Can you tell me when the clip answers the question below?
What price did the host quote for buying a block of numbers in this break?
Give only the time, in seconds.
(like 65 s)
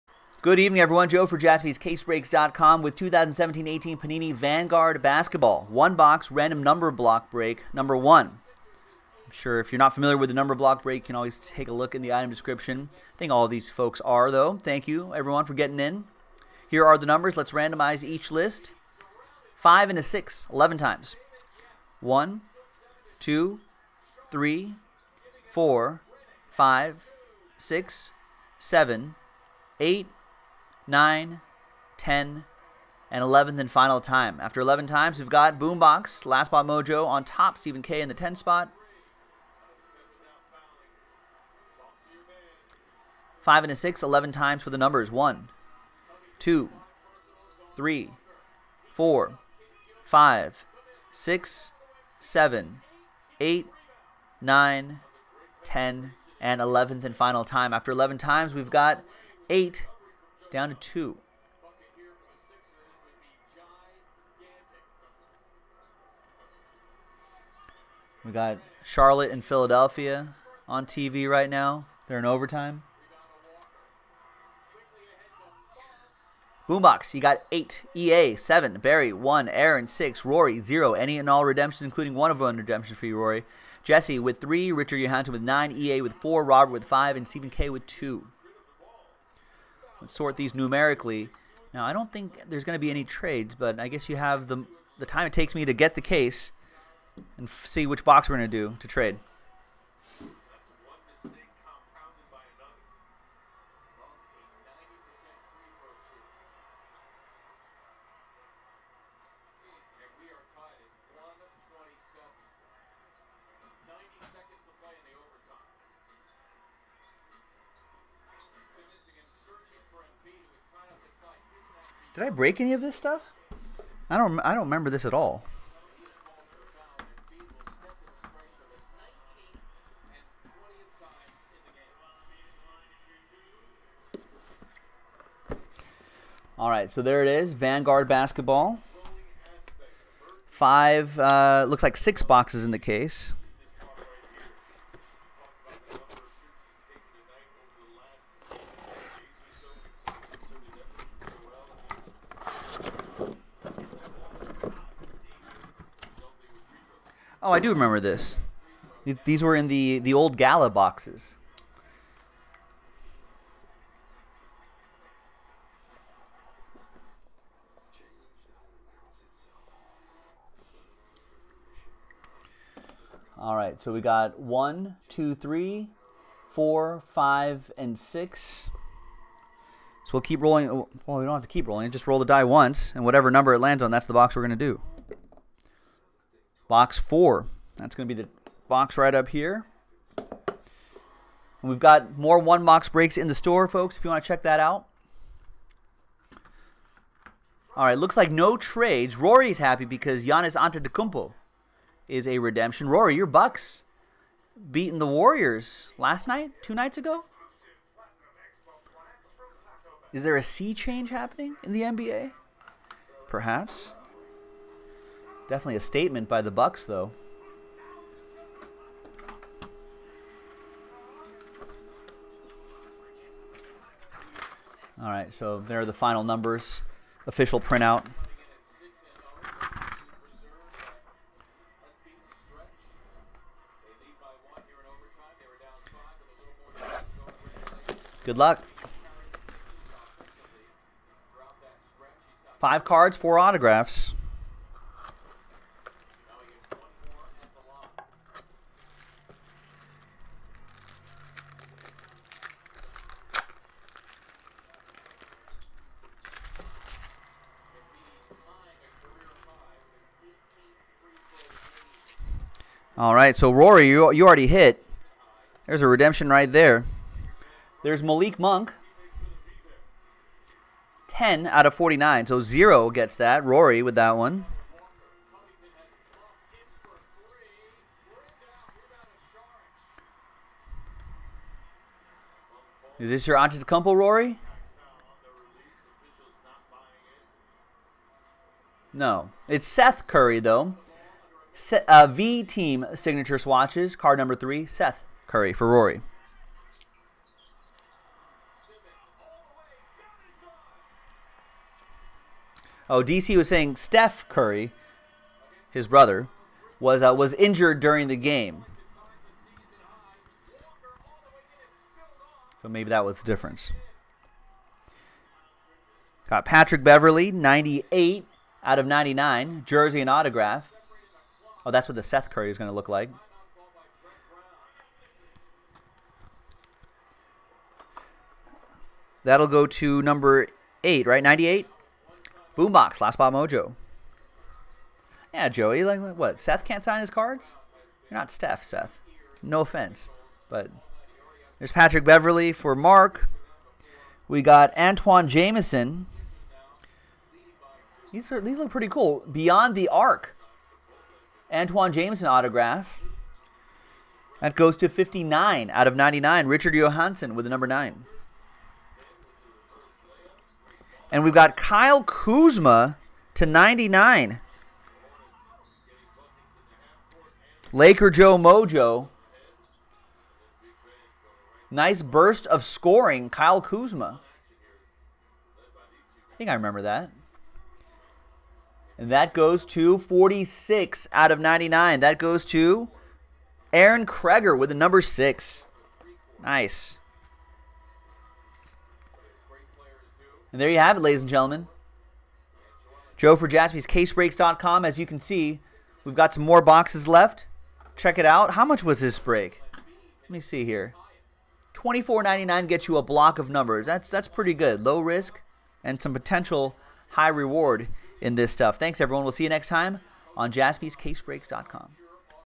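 401 s.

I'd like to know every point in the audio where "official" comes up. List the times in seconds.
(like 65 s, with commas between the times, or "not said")
227 s.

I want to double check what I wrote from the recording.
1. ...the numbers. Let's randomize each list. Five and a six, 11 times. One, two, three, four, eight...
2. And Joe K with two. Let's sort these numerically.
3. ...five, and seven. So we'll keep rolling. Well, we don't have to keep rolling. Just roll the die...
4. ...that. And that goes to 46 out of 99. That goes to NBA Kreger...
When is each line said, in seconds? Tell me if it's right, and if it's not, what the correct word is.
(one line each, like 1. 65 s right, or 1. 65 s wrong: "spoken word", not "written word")
1. 16 s wrong: "five", not "eight"
2. 87 s wrong: "Stephen", not "Joe"
3. 177 s wrong: "six", not "seven"
4. 376 s wrong: "Aaron", not "NBA".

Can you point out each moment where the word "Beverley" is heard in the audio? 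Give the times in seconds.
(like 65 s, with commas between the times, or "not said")
316 s, 342 s.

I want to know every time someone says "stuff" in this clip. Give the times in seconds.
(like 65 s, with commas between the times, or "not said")
122 s, 408 s.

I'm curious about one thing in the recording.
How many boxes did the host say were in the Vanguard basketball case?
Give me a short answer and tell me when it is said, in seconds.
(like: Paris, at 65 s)
6, at 141 s.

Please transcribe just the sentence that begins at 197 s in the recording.
All right, looks like no trades.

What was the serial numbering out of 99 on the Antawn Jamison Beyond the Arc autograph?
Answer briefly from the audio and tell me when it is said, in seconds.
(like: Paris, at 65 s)
59, at 354 s.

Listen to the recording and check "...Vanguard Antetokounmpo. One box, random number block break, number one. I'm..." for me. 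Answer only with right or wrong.
wrong.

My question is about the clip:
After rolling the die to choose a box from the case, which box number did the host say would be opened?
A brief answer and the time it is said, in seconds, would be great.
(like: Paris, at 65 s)
4, at 186 s.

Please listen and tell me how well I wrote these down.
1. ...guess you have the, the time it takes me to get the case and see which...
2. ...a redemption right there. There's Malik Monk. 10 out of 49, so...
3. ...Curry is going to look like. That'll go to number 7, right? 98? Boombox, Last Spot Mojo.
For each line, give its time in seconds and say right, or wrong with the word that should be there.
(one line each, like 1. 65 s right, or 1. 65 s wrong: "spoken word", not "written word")
1. 93 s right
2. 265 s right
3. 322 s wrong: "8", not "7".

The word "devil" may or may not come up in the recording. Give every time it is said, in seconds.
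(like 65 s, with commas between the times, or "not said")
not said.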